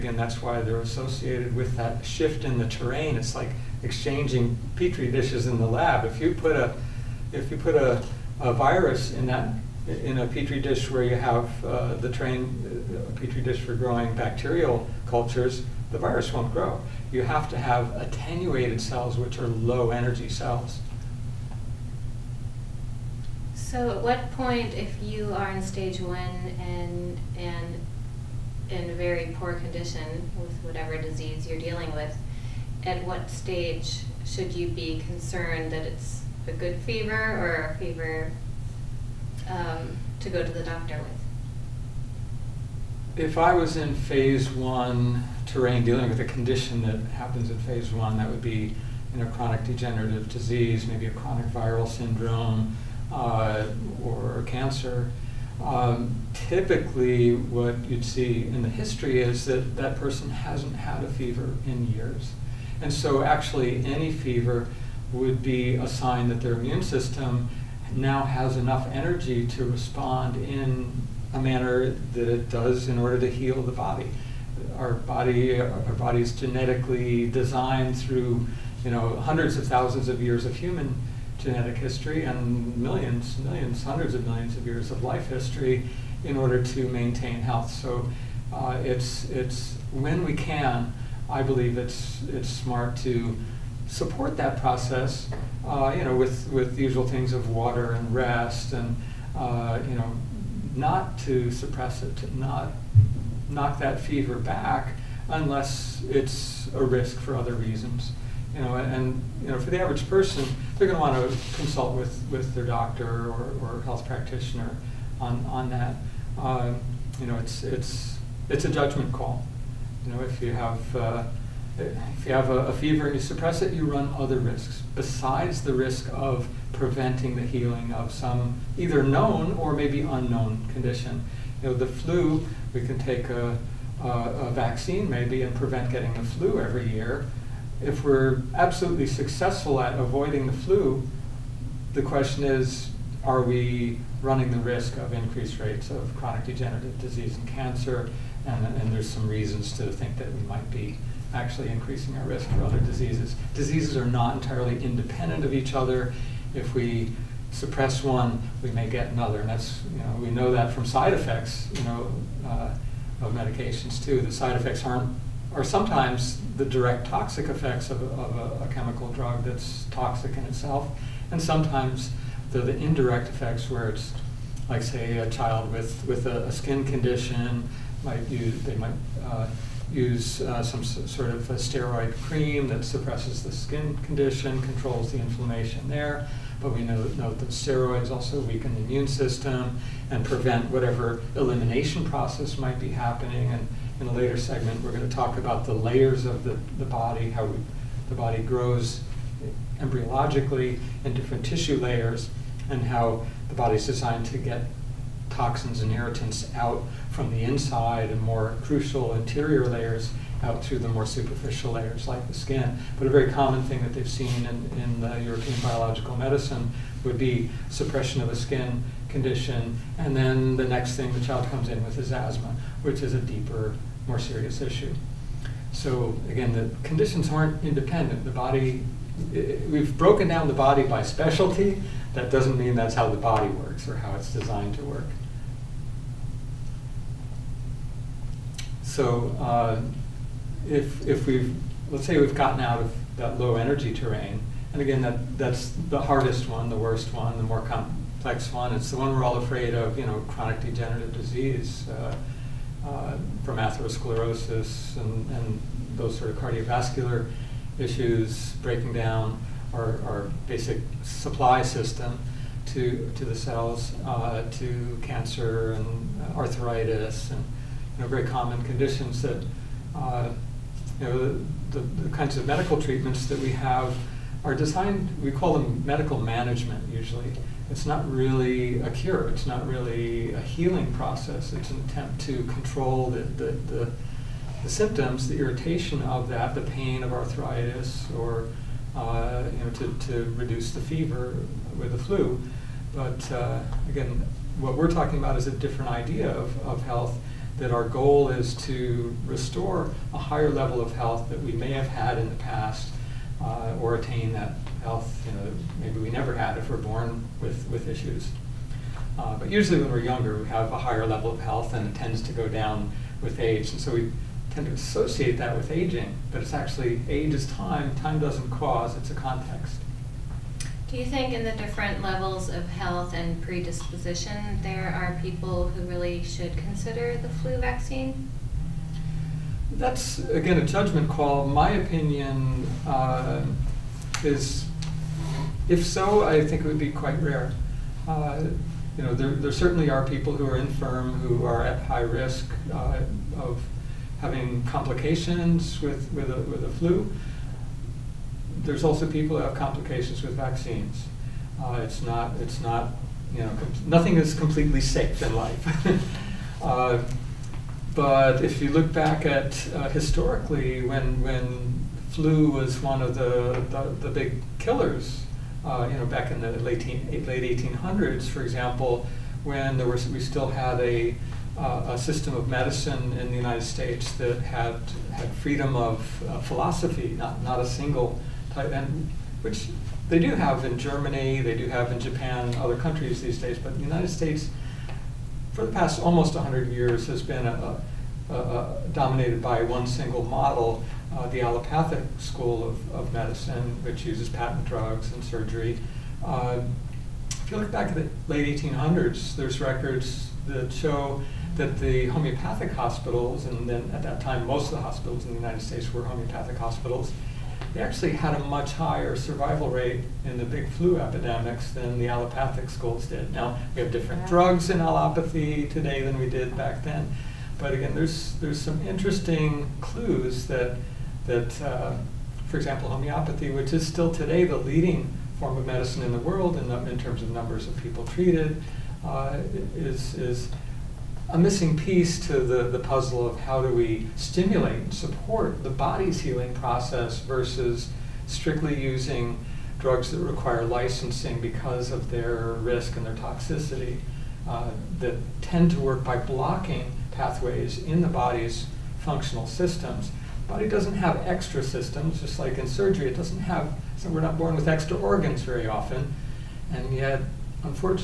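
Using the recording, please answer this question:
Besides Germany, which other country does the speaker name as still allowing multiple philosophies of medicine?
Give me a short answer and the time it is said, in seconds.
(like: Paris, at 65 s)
Japan, at 381 s.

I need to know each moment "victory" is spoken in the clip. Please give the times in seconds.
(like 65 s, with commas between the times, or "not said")
not said.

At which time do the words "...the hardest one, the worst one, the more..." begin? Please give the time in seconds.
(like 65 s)
245 s.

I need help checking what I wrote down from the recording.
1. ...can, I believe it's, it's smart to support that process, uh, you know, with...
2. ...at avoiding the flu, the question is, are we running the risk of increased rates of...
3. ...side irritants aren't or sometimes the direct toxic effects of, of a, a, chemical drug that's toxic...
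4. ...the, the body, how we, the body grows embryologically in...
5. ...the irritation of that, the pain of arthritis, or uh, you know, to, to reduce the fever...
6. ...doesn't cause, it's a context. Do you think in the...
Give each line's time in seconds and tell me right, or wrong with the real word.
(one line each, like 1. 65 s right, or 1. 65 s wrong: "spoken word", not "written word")
1. 90 s right
2. 139 s right
3. 164 s wrong: "effects", not "irritants"
4. 196 s right
5. 285 s right
6. 318 s right.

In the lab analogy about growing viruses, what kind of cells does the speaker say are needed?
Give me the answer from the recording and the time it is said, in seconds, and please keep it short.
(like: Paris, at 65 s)
Attenuated cells, at 17 s.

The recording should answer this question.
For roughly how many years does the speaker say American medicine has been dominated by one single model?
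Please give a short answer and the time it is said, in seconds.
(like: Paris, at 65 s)
Almost 100 years, at 386 s.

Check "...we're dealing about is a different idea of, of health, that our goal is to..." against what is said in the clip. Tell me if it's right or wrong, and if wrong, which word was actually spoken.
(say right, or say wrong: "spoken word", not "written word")
wrong: "talking", not "dealing".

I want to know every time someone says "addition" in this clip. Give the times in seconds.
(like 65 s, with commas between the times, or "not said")
not said.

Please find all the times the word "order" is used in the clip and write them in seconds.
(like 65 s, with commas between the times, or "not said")
72 s, 86 s.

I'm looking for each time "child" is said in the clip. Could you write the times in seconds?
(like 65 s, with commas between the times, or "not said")
175 s, 221 s.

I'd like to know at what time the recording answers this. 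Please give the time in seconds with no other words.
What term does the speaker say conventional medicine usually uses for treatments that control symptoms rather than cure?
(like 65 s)
275 s.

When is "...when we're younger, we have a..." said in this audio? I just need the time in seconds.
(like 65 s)
309 s.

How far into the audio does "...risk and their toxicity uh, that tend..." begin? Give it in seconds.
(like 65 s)
442 s.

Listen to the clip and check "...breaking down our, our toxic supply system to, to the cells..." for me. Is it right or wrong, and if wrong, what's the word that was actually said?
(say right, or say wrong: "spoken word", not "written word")
wrong: "basic", not "toxic".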